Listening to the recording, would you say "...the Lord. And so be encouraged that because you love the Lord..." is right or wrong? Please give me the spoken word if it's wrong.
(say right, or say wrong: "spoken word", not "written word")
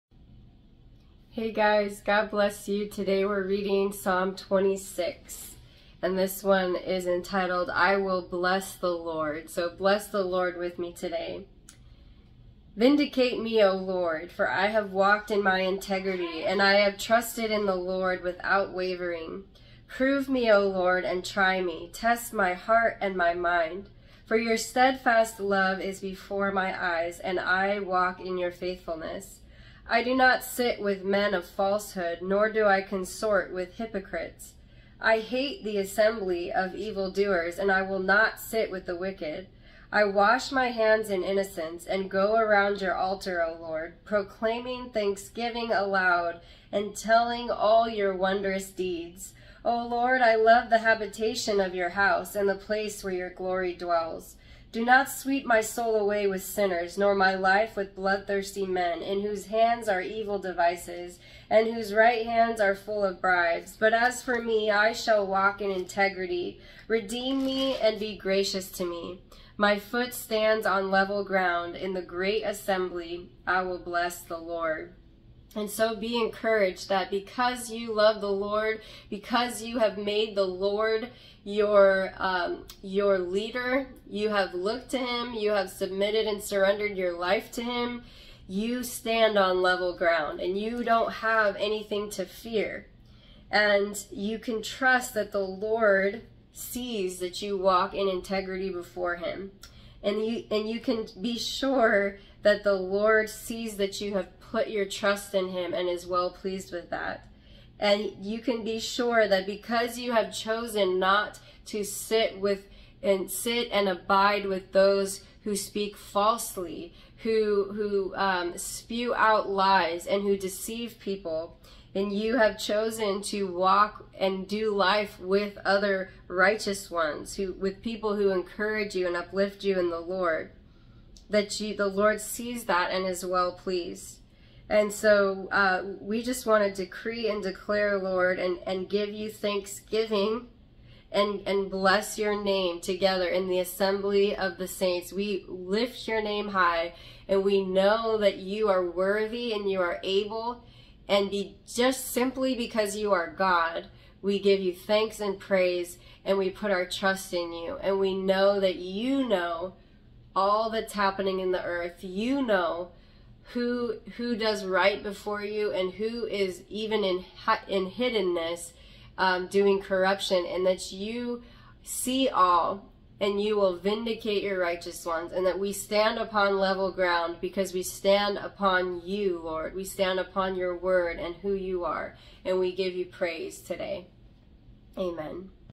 right.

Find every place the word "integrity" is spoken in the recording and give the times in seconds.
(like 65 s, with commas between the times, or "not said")
15 s, 65 s, 98 s.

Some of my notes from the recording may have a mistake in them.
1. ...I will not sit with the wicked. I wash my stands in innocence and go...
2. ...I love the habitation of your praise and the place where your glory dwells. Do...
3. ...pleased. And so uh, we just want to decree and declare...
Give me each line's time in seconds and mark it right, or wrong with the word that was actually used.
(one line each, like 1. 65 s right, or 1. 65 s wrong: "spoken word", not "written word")
1. 37 s wrong: "hands", not "stands"
2. 50 s wrong: "house", not "praise"
3. 133 s right.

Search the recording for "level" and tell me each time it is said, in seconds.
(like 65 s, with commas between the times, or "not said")
70 s, 89 s, 176 s.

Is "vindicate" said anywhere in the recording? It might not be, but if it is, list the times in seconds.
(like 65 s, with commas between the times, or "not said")
12 s, 173 s.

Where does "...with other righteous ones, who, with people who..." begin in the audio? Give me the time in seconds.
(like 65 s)
125 s.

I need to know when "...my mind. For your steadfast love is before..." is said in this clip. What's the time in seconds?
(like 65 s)
23 s.